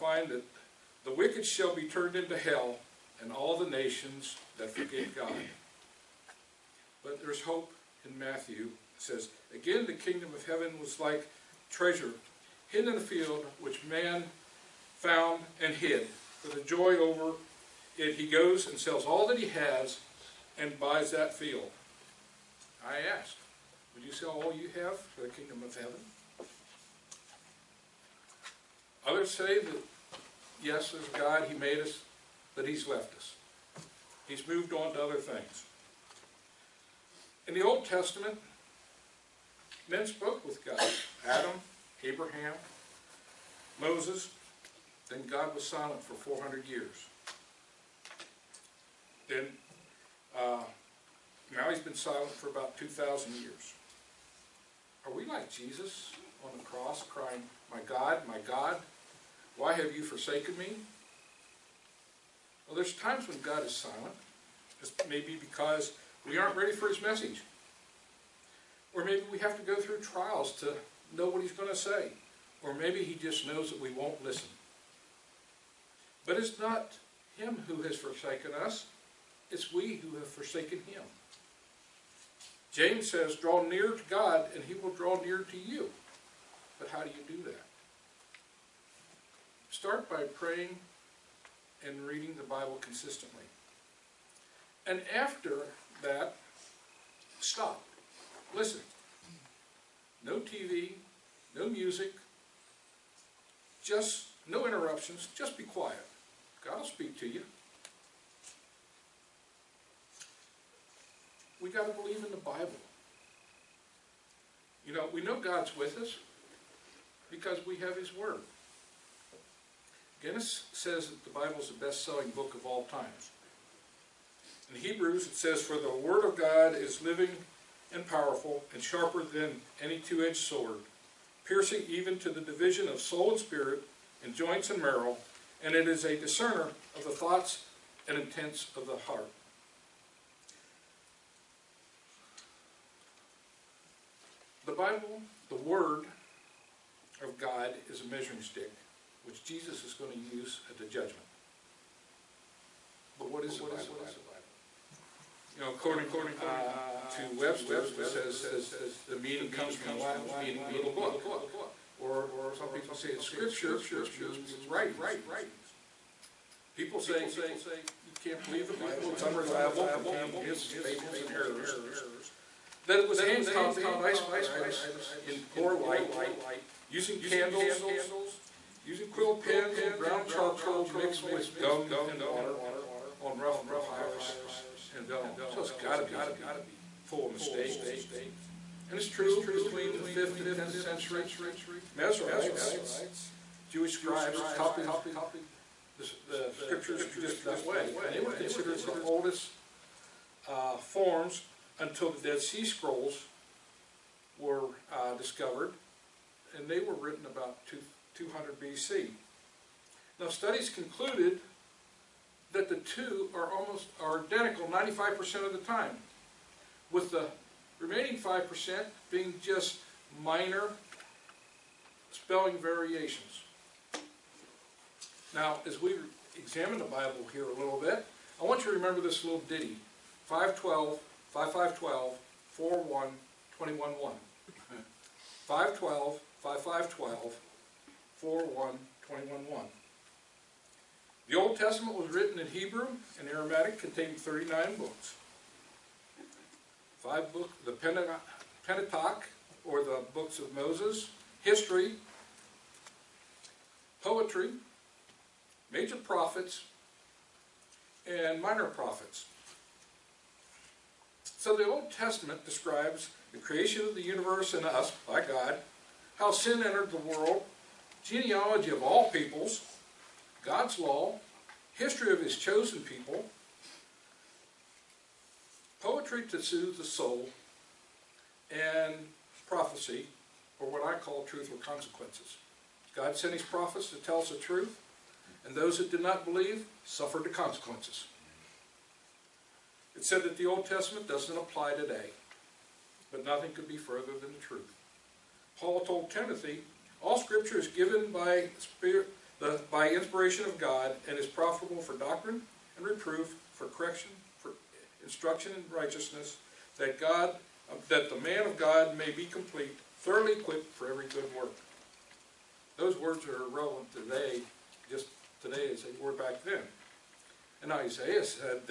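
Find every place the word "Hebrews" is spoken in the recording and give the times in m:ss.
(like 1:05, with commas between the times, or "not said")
2:04, 4:02.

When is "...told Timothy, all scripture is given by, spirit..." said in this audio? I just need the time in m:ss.
4:55.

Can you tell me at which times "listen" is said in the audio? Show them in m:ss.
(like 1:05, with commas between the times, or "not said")
1:14, 1:38.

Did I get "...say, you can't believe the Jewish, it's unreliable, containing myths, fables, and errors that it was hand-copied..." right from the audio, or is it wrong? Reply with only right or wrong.
wrong.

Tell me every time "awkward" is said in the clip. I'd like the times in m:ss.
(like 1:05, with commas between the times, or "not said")
not said.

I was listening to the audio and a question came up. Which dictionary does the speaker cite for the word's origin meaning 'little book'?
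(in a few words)
Webster.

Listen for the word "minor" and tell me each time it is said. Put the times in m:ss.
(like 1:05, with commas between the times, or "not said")
3:40, 4:18.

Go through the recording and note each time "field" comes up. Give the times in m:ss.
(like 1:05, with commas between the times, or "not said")
0:13, 0:21.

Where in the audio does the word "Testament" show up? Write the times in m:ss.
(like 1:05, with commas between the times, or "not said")
0:37, 4:01, 4:21, 4:50.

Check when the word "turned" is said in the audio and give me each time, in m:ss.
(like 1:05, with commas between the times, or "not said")
0:01.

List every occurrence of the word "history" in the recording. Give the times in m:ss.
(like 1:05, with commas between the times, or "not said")
4:11, 4:31.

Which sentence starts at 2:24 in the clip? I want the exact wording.
Bible, the Word of God, is a measuring stick which Jesus is going to use at the judgment.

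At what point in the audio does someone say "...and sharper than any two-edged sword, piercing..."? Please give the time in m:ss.
2:08.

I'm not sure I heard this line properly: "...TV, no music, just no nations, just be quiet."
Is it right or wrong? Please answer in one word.
wrong.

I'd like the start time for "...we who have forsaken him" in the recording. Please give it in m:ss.
1:19.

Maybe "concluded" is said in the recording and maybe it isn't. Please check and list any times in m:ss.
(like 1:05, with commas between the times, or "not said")
3:30.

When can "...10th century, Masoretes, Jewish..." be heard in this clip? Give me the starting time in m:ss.
3:10.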